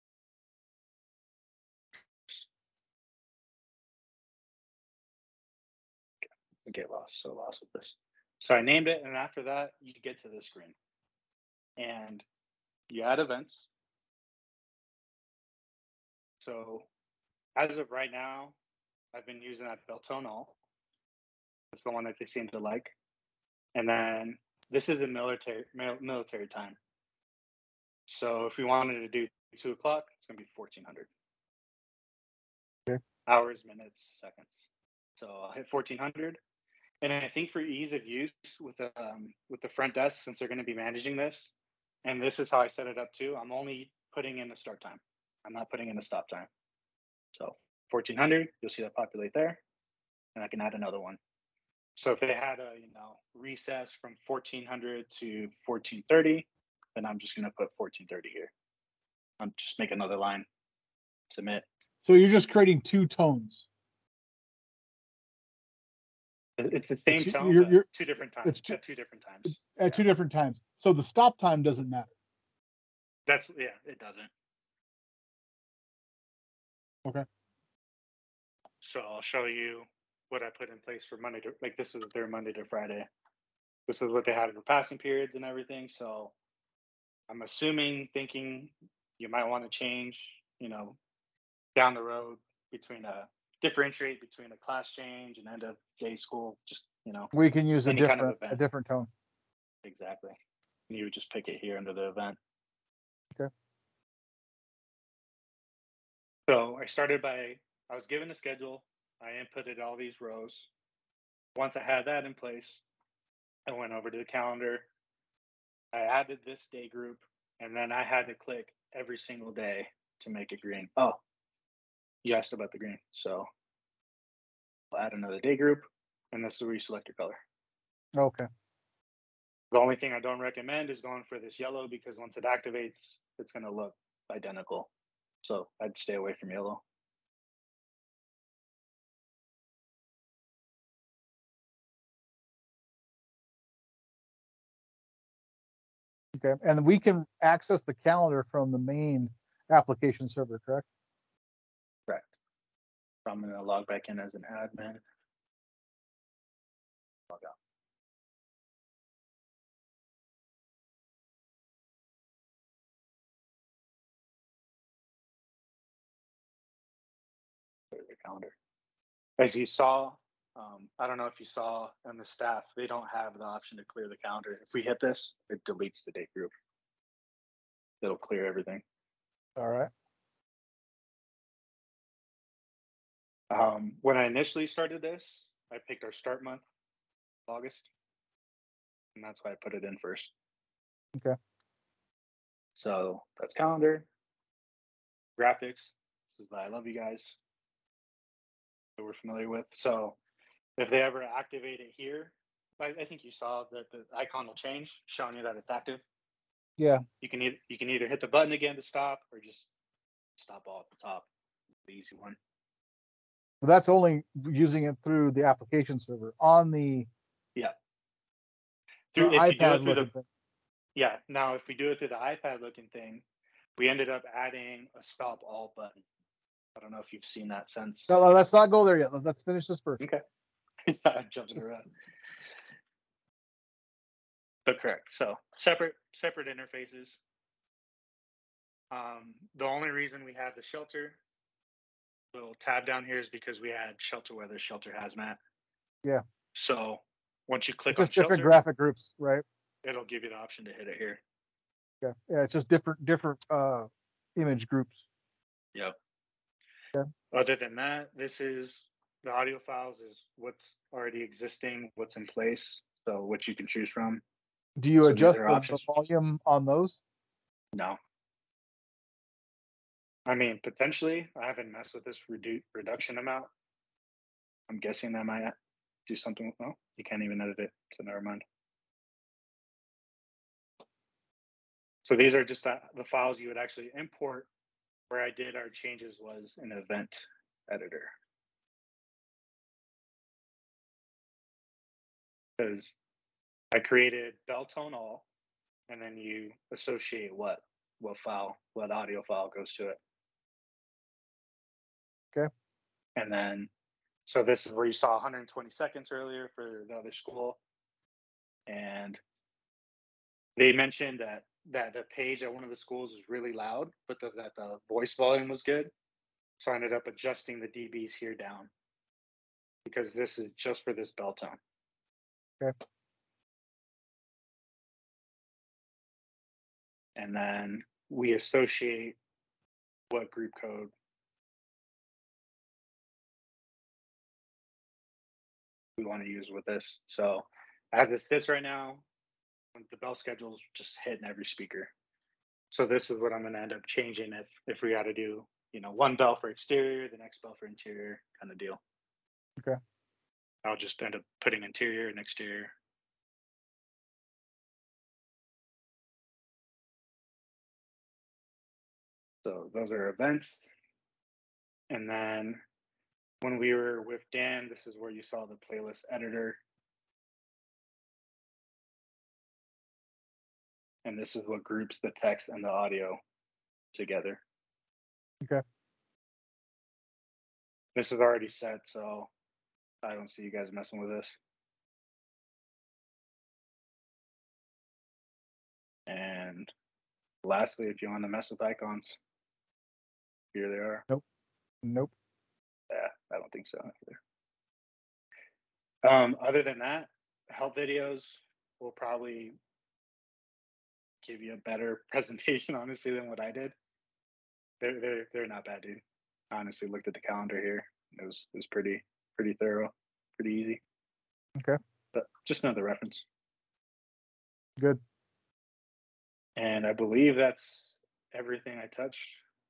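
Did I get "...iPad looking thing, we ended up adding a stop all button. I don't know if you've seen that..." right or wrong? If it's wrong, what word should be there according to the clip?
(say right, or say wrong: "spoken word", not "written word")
right.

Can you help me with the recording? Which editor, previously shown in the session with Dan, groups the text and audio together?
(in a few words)
playlist editor.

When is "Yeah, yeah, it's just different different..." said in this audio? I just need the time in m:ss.
4:12.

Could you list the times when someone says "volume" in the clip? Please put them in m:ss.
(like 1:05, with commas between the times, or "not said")
4:25, 5:15.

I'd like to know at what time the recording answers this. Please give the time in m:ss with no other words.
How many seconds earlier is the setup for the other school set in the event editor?
5:05.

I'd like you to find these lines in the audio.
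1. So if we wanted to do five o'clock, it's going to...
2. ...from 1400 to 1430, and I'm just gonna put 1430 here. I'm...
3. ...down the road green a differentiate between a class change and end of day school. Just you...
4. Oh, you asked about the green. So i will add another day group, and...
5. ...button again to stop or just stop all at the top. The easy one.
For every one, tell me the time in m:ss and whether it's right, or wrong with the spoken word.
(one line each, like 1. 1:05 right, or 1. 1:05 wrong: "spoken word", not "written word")
1. 0:28 wrong: "two", not "five"
2. 0:54 right
3. 1:31 wrong: "between", not "green"
4. 2:00 right
5. 3:28 right.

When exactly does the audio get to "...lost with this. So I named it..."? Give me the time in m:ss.
0:07.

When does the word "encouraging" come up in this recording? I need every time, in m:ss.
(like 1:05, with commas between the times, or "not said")
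not said.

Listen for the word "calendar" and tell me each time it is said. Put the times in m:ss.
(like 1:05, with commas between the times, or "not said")
1:54, 2:28, 2:48, 2:54, 3:13, 6:47.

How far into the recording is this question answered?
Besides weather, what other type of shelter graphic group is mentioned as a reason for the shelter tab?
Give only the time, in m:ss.
4:04.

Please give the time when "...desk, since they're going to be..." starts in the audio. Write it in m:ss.
0:39.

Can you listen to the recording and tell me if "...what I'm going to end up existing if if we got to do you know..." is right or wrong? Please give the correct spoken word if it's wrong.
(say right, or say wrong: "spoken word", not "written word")
wrong: "changing", not "existing".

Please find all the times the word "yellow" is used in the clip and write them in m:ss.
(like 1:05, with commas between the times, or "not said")
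2:11, 2:16.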